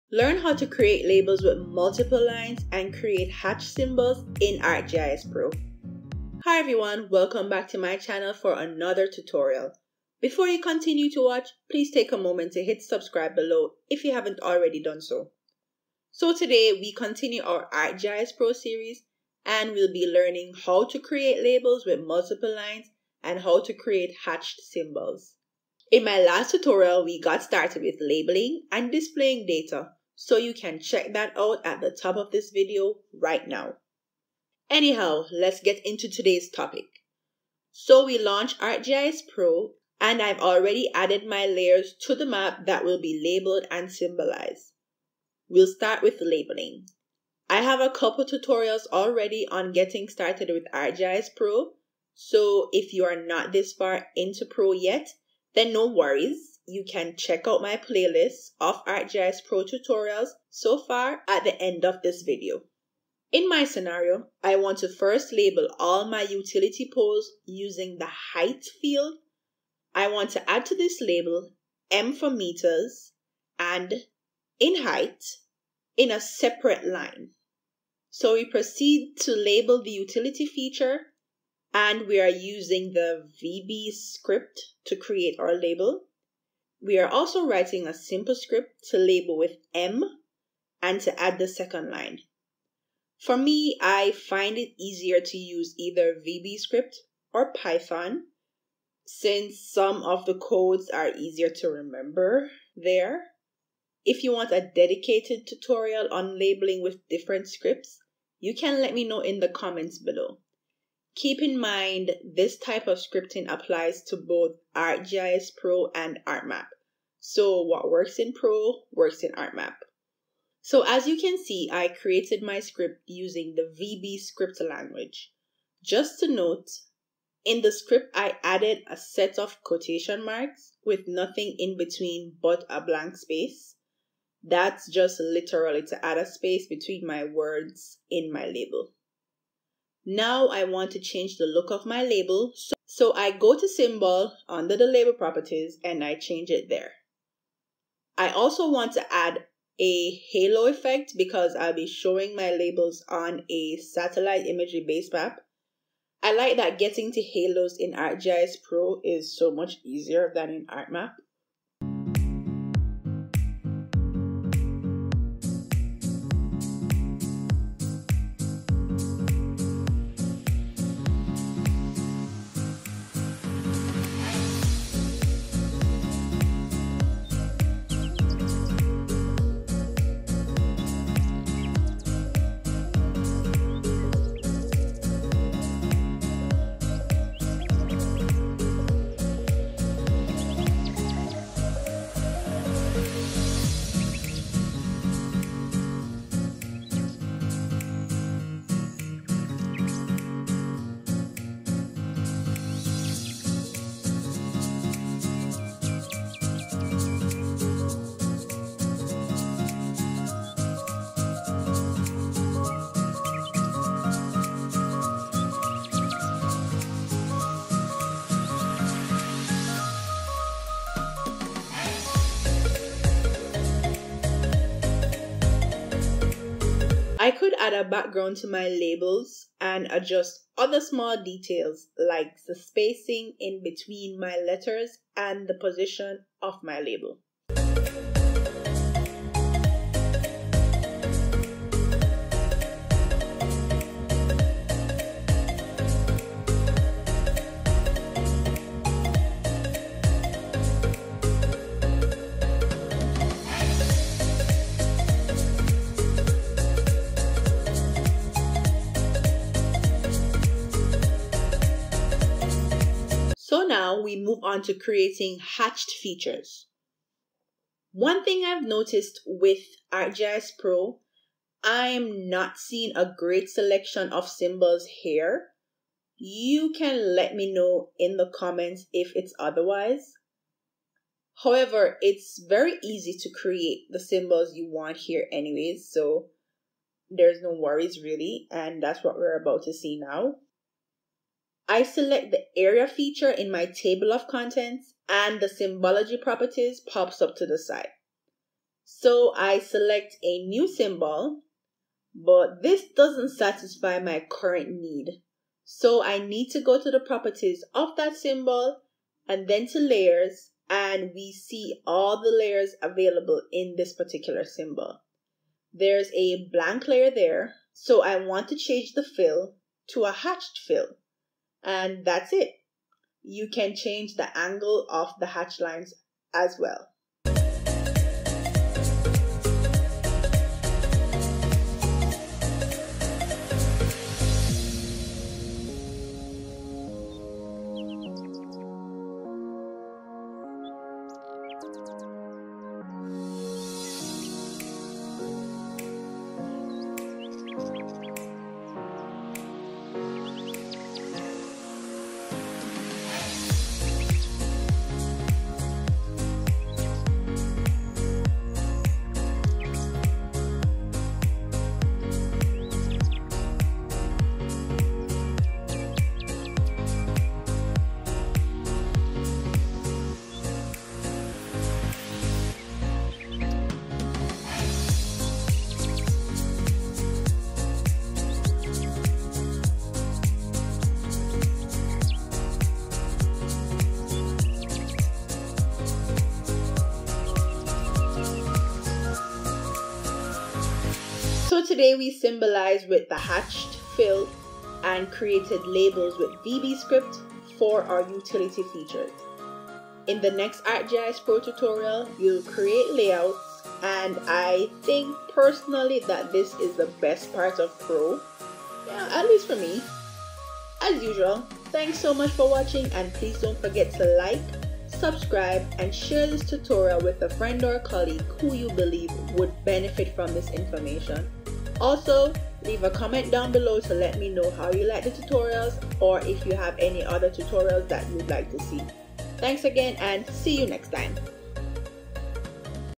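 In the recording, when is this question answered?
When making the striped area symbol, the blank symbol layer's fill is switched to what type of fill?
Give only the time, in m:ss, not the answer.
5:20.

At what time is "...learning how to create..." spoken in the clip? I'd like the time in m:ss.
0:20.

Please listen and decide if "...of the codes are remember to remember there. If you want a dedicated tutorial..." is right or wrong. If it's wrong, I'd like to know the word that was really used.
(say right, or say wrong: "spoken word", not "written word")
wrong: "easier", not "remember".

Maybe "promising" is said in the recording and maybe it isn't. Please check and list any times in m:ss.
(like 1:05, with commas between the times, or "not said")
not said.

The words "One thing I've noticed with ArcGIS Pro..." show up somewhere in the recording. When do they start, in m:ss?
4:27.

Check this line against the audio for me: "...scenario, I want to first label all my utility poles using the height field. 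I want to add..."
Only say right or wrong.
right.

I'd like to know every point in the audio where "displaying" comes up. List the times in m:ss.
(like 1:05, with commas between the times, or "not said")
0:28.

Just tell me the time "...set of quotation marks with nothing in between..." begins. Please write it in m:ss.
2:08.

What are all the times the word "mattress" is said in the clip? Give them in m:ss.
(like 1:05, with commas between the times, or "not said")
not said.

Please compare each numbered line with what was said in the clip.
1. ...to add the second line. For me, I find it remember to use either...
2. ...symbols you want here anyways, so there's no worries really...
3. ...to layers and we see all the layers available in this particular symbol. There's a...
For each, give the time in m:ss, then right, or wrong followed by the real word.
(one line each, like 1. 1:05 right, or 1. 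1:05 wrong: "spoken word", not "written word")
1. 1:30 wrong: "easier", not "remember"
2. 4:43 right
3. 5:09 right.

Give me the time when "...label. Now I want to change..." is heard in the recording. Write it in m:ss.
2:18.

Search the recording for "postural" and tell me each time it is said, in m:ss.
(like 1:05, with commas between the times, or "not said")
not said.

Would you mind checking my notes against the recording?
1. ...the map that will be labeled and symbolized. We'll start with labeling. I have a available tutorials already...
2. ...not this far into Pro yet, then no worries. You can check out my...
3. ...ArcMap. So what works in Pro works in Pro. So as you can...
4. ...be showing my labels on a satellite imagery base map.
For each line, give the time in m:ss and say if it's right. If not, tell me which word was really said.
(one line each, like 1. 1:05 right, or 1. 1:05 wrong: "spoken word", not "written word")
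1. 0:42 wrong: "couple", not "available"
2. 0:53 right
3. 1:56 wrong: "ArcMap", not "Pro"
4. 2:31 right.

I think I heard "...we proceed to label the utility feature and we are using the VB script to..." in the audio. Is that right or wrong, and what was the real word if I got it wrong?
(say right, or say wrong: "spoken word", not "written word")
right.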